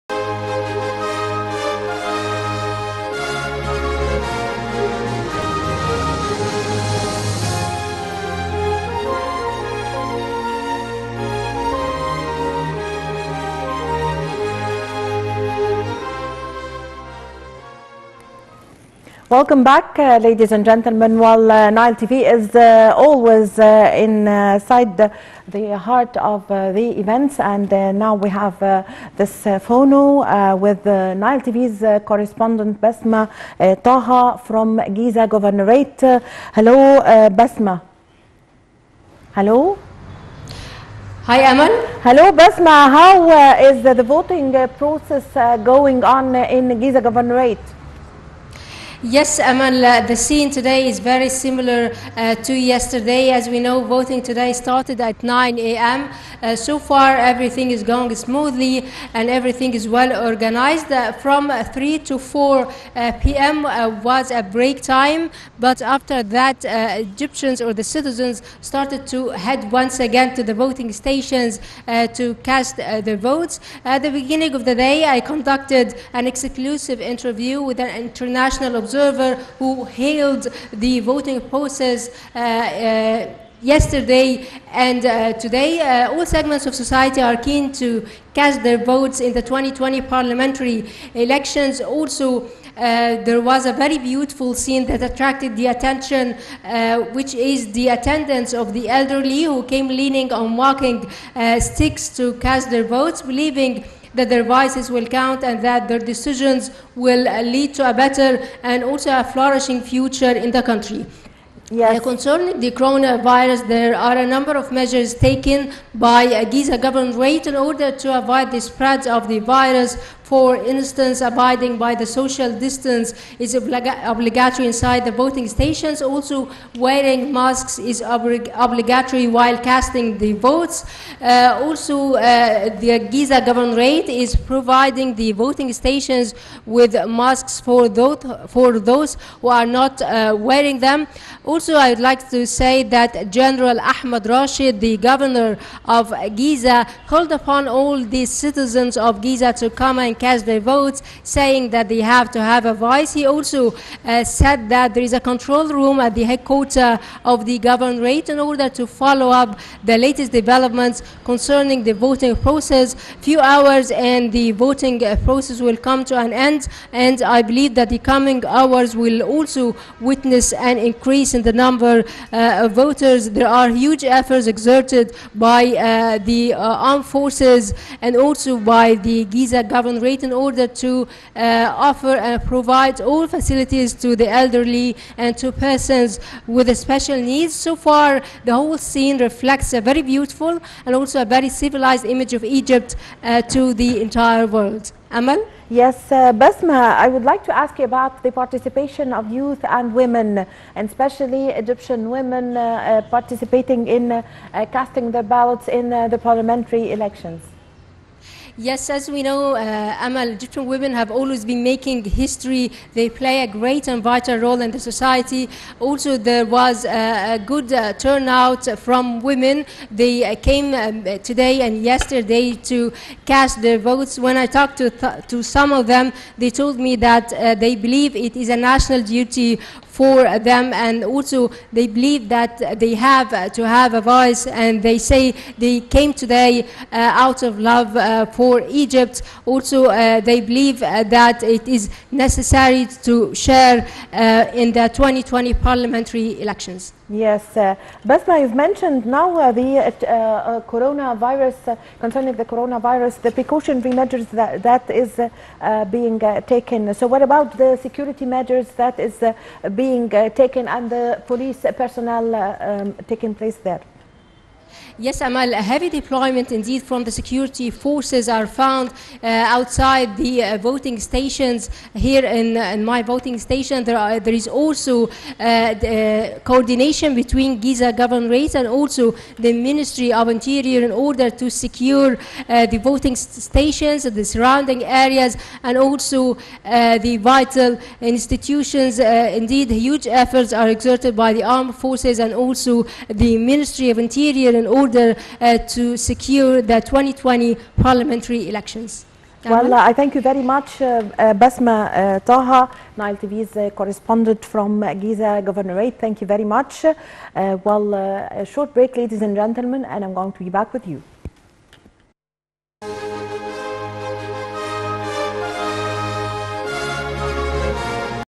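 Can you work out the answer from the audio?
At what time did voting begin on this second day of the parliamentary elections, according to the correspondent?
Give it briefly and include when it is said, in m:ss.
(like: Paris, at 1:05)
9 a.m., at 0:55.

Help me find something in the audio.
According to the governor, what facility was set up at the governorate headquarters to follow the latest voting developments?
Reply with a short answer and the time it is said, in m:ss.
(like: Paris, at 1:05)
control room, at 2:35.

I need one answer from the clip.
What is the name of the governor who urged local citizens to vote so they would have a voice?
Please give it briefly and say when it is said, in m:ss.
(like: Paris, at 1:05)
General Ahmad Rashid, at 2:23.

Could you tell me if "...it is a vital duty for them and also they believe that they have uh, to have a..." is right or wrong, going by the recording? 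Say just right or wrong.
wrong.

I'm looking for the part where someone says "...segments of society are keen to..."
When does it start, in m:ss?
1:26.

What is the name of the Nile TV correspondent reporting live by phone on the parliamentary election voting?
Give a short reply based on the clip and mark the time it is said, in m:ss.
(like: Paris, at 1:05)
Basma Taha, at 0:32.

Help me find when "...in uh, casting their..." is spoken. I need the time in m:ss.
3:23.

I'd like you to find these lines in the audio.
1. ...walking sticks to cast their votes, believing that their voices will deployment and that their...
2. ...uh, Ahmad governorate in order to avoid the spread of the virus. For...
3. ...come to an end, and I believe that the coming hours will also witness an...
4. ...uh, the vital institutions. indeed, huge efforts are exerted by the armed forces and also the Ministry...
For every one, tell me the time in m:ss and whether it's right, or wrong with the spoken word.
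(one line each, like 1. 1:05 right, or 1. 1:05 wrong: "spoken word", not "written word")
1. 1:40 wrong: "count", not "deployment"
2. 1:56 wrong: "Giza", not "Ahmad"
3. 2:45 right
4. 4:46 right.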